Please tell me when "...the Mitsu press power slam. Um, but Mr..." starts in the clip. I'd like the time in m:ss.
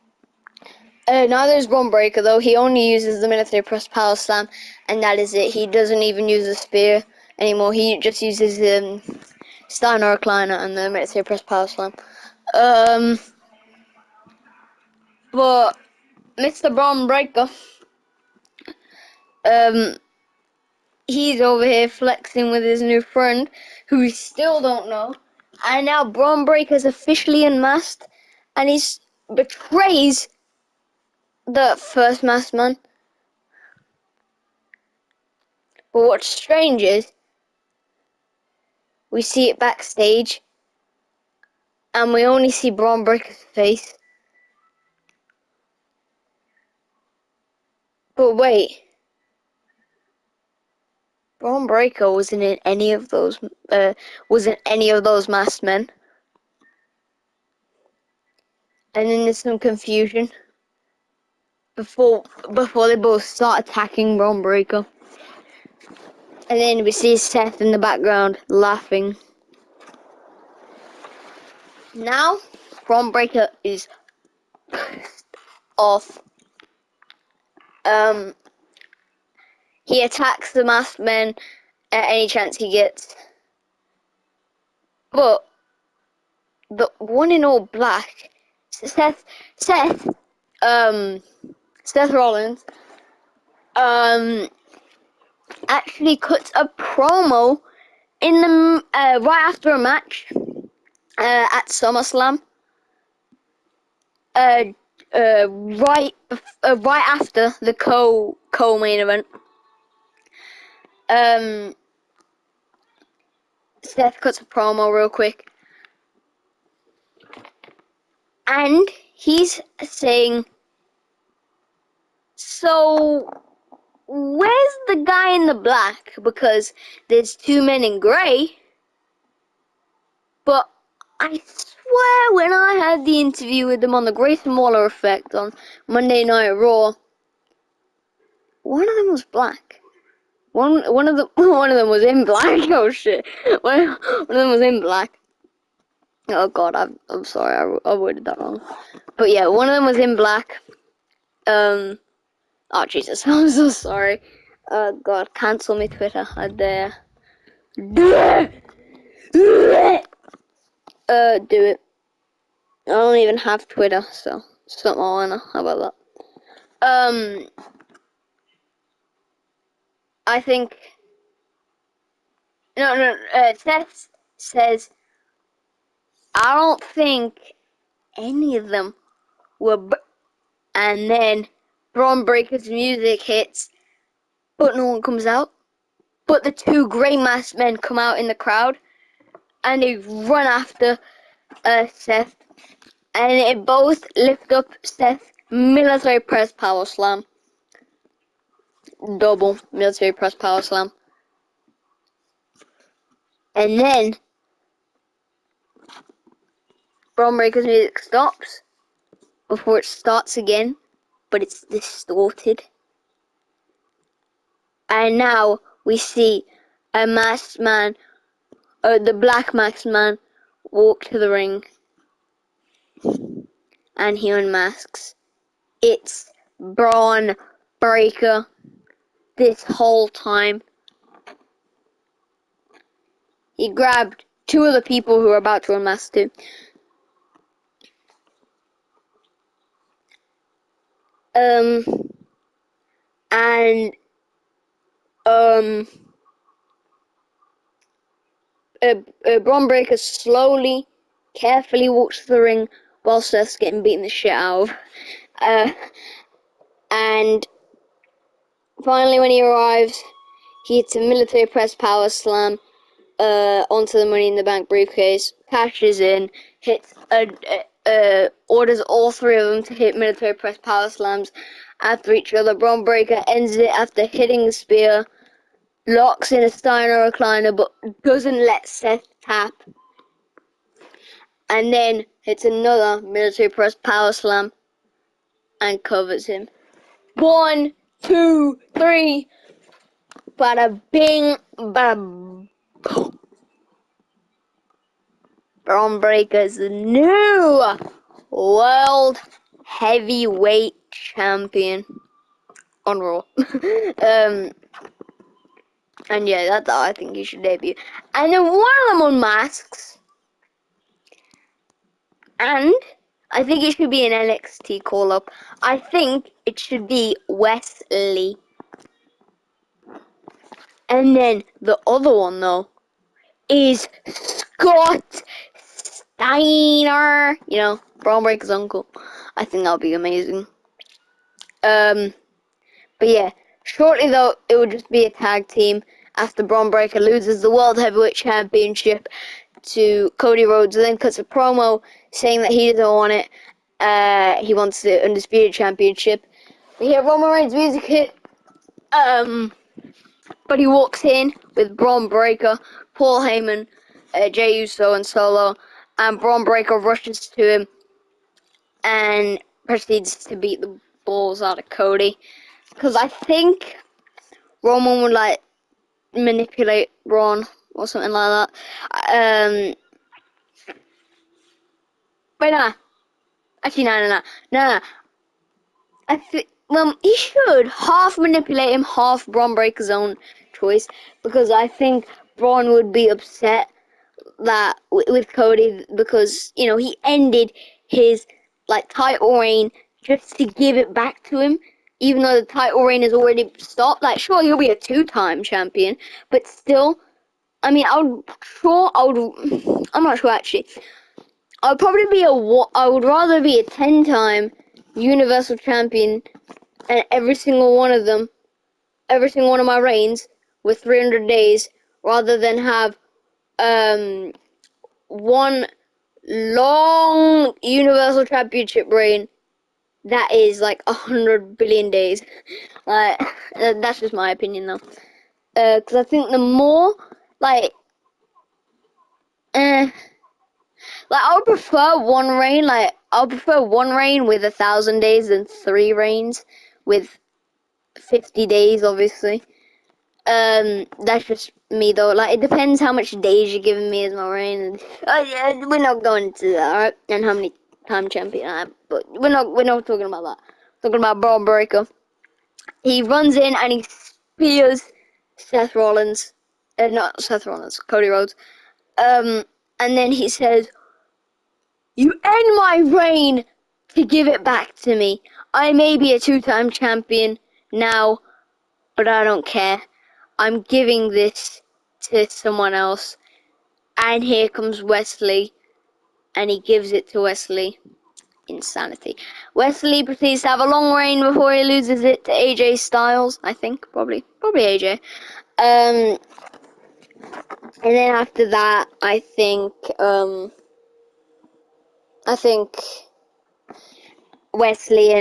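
0:10.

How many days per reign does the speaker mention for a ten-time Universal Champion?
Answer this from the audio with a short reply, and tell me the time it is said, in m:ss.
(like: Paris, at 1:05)
300, at 6:50.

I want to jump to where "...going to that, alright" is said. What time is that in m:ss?
7:26.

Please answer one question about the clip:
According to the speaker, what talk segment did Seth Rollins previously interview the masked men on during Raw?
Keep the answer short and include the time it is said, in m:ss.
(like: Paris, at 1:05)
Grayson Waller Effect, at 2:14.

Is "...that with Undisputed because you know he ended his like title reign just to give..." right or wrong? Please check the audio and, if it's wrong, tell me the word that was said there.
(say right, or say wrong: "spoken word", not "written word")
wrong: "Cody", not "Undisputed".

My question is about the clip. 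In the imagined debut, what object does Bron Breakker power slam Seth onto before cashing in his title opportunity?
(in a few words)
Money in the Bank briefcase.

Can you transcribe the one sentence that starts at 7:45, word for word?
I may be a two-time champion now, but I don't care." I'm giving this to someone else.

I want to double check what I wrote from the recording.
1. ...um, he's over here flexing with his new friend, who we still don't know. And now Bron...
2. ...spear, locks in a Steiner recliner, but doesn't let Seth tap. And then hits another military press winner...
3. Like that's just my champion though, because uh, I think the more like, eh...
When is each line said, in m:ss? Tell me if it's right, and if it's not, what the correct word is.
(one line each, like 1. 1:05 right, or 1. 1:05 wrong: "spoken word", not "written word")
1. 0:19 right
2. 4:34 wrong: "power", not "winner"
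3. 7:02 wrong: "opinion", not "champion".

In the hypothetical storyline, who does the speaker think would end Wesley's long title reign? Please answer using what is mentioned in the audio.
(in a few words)
AJ Styles.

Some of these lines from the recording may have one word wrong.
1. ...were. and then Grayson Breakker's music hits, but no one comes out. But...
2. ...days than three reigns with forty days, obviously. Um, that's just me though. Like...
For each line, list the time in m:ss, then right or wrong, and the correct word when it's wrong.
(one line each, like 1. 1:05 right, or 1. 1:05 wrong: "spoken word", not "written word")
1. 2:59 wrong: "Bron", not "Grayson"
2. 7:15 wrong: "fifty", not "forty".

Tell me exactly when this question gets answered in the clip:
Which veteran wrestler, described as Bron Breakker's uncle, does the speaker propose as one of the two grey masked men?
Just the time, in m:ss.
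5:24.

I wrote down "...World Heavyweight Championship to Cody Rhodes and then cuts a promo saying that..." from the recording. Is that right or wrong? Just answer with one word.
right.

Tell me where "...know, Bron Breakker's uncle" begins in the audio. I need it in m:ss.
5:27.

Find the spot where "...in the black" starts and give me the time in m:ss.
2:05.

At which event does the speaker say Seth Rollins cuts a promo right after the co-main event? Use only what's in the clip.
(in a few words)
SummerSlam.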